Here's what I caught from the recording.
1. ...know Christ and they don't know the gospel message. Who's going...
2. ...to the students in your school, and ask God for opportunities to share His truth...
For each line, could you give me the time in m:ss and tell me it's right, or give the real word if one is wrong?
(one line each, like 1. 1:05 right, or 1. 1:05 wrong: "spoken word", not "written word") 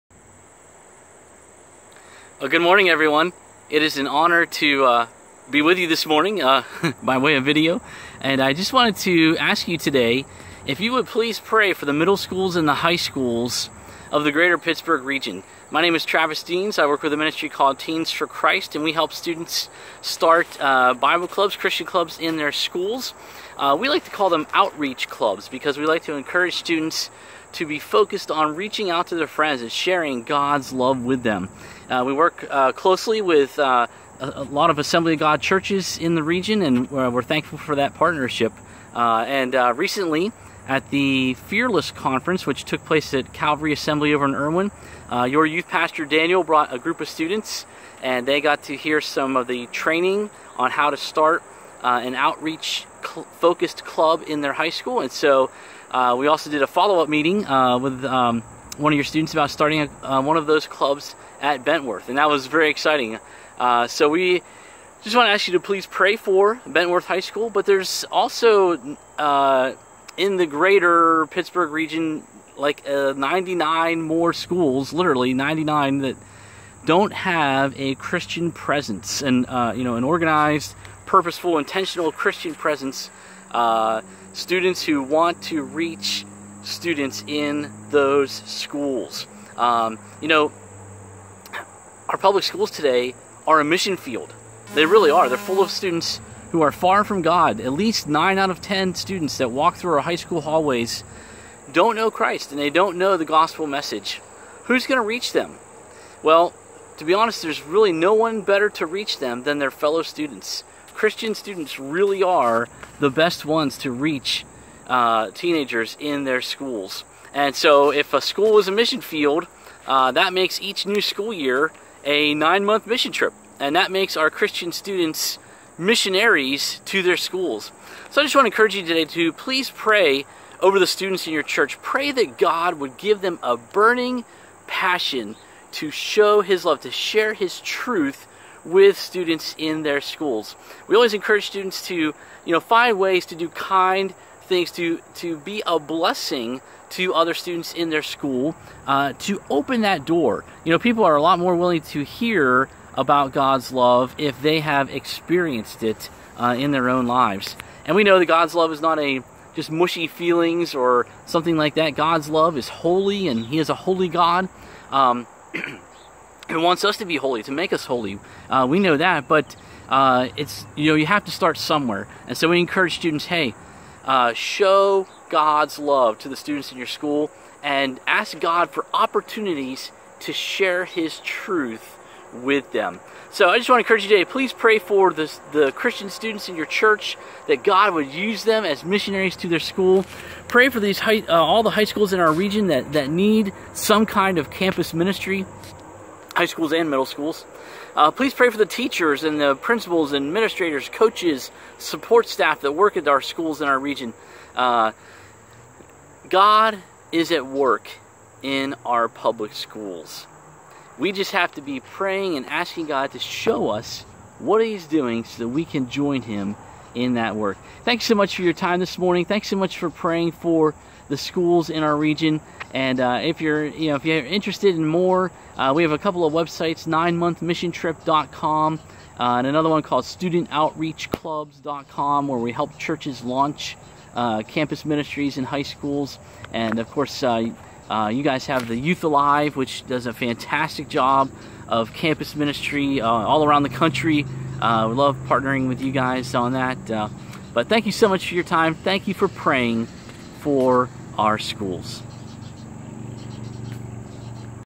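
1. 1:41 right
2. 2:56 right.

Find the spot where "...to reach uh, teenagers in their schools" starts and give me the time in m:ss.
1:53.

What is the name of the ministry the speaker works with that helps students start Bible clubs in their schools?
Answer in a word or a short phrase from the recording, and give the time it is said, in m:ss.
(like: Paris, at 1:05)
Teens for Christ, at 0:17.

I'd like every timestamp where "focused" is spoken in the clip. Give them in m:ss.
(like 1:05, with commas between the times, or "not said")
0:27, 0:53.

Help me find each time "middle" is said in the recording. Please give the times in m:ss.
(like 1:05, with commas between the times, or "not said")
0:11, 3:16.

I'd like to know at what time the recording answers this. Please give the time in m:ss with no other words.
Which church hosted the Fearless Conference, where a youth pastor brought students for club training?
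0:43.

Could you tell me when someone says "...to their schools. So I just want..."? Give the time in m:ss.
2:06.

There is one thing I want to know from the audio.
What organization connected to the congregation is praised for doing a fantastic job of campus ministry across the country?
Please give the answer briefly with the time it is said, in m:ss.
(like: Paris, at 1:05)
Youth Alive, at 3:58.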